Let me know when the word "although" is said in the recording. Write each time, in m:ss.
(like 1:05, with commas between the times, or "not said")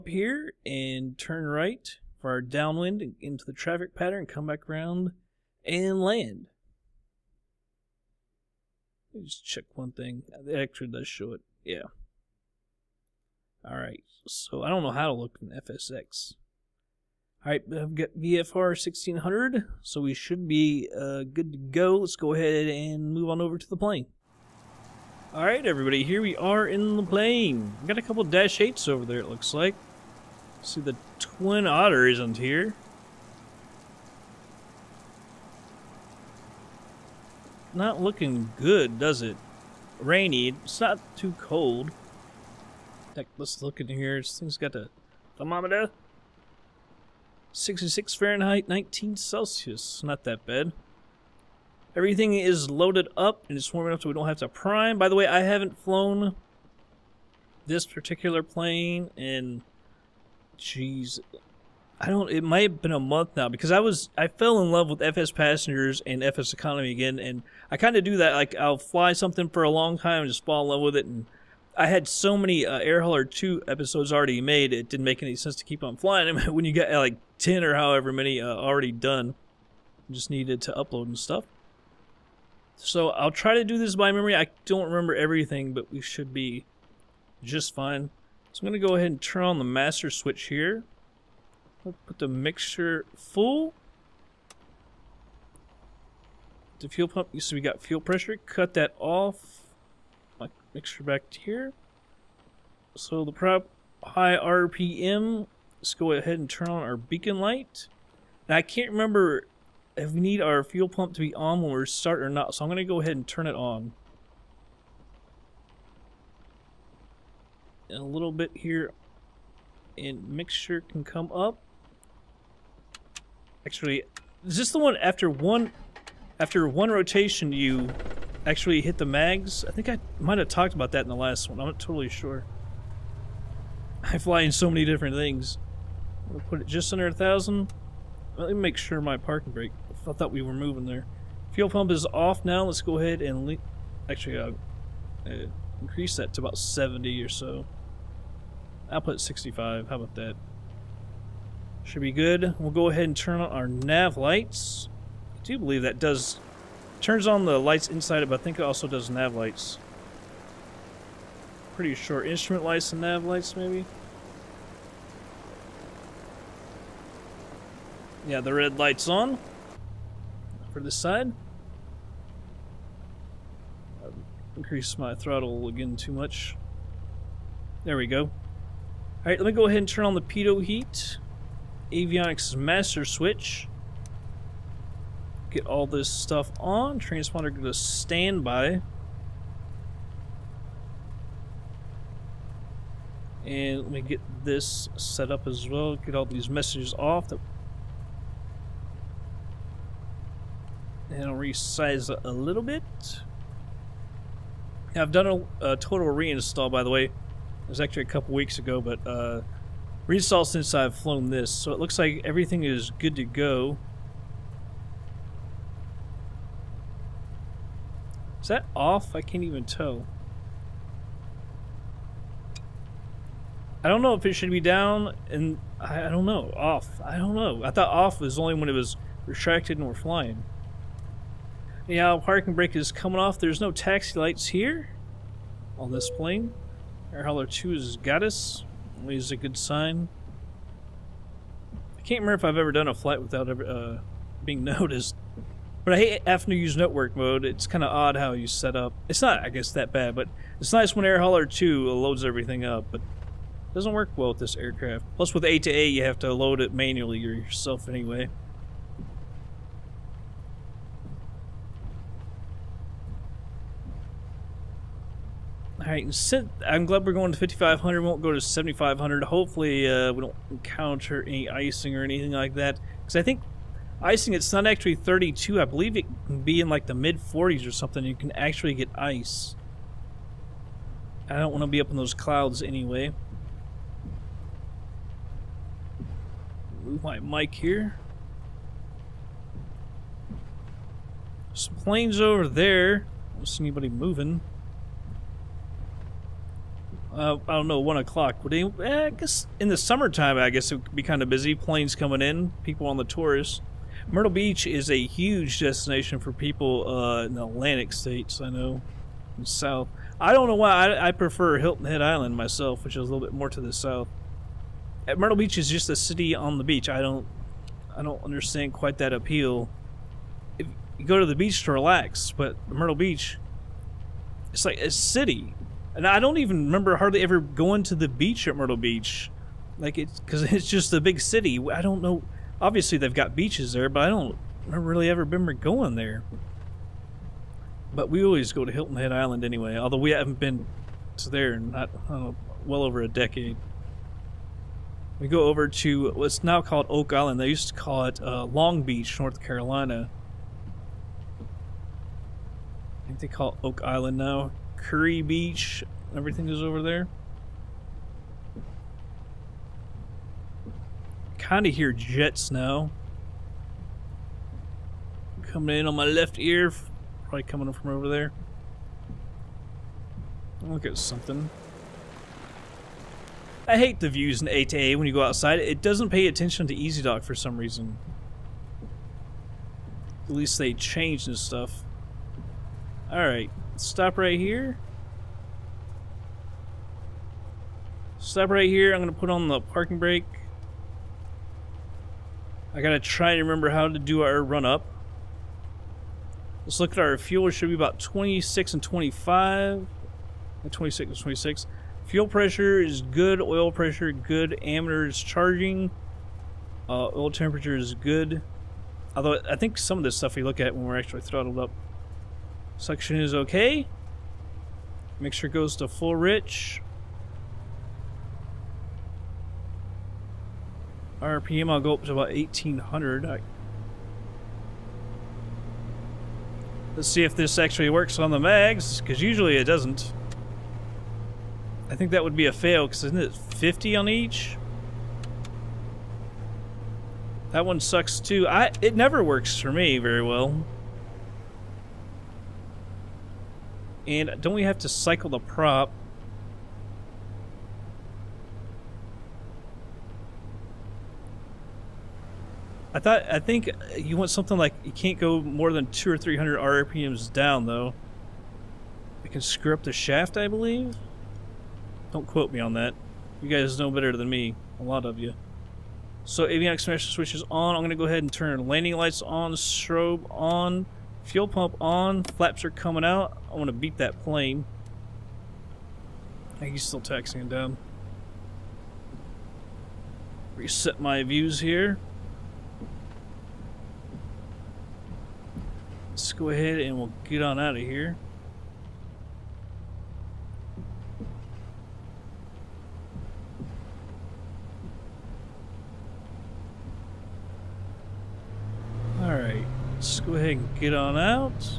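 5:39, 6:49.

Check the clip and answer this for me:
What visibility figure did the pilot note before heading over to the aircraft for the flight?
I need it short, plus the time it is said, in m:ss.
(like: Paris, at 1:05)
VFR 1600, at 0:18.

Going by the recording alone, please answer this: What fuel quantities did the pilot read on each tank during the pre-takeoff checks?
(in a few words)
26 and 26.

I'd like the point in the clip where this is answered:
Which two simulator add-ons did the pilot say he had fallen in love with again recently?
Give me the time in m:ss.
1:05.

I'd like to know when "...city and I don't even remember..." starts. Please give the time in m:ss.
5:24.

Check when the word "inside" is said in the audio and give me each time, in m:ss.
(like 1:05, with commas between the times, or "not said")
2:37.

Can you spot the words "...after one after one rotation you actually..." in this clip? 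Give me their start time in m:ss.
2:04.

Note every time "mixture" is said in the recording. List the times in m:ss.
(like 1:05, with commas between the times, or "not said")
1:32, 1:40, 2:00, 6:55.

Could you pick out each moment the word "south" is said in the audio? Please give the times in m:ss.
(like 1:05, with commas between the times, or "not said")
5:09, 5:13.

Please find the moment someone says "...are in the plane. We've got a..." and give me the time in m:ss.
0:26.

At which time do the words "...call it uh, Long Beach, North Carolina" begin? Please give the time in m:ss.
5:47.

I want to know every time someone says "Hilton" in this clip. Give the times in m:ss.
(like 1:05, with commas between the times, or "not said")
5:11, 5:38.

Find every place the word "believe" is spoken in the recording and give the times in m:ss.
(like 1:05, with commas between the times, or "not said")
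2:35, 4:35, 7:40.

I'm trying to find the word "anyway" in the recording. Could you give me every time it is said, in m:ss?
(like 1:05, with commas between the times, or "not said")
4:17, 4:42, 5:39.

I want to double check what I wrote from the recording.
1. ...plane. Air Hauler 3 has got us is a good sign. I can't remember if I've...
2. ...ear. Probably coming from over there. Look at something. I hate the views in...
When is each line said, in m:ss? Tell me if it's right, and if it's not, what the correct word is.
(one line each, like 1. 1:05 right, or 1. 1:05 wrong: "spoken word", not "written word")
1. 3:56 wrong: "2", not "3"
2. 6:06 right.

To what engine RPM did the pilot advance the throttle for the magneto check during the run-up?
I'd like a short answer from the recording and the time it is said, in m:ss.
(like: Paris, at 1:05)
1800, at 7:02.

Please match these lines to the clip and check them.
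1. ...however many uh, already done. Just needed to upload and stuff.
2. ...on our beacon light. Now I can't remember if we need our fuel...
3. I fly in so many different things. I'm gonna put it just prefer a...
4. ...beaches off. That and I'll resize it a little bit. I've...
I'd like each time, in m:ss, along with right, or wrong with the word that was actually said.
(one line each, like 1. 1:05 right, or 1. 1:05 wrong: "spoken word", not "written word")
1. 1:17 right
2. 1:46 right
3. 2:14 wrong: "under", not "prefer"
4. 3:16 wrong: "messages", not "beaches".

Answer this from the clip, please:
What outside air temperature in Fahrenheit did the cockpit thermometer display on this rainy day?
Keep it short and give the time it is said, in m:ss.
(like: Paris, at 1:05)
66, at 0:47.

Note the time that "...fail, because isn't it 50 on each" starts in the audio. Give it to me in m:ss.
7:12.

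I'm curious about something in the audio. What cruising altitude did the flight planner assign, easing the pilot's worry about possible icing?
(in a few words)
5,500.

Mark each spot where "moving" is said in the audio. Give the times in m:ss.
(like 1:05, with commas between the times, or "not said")
2:20, 4:53.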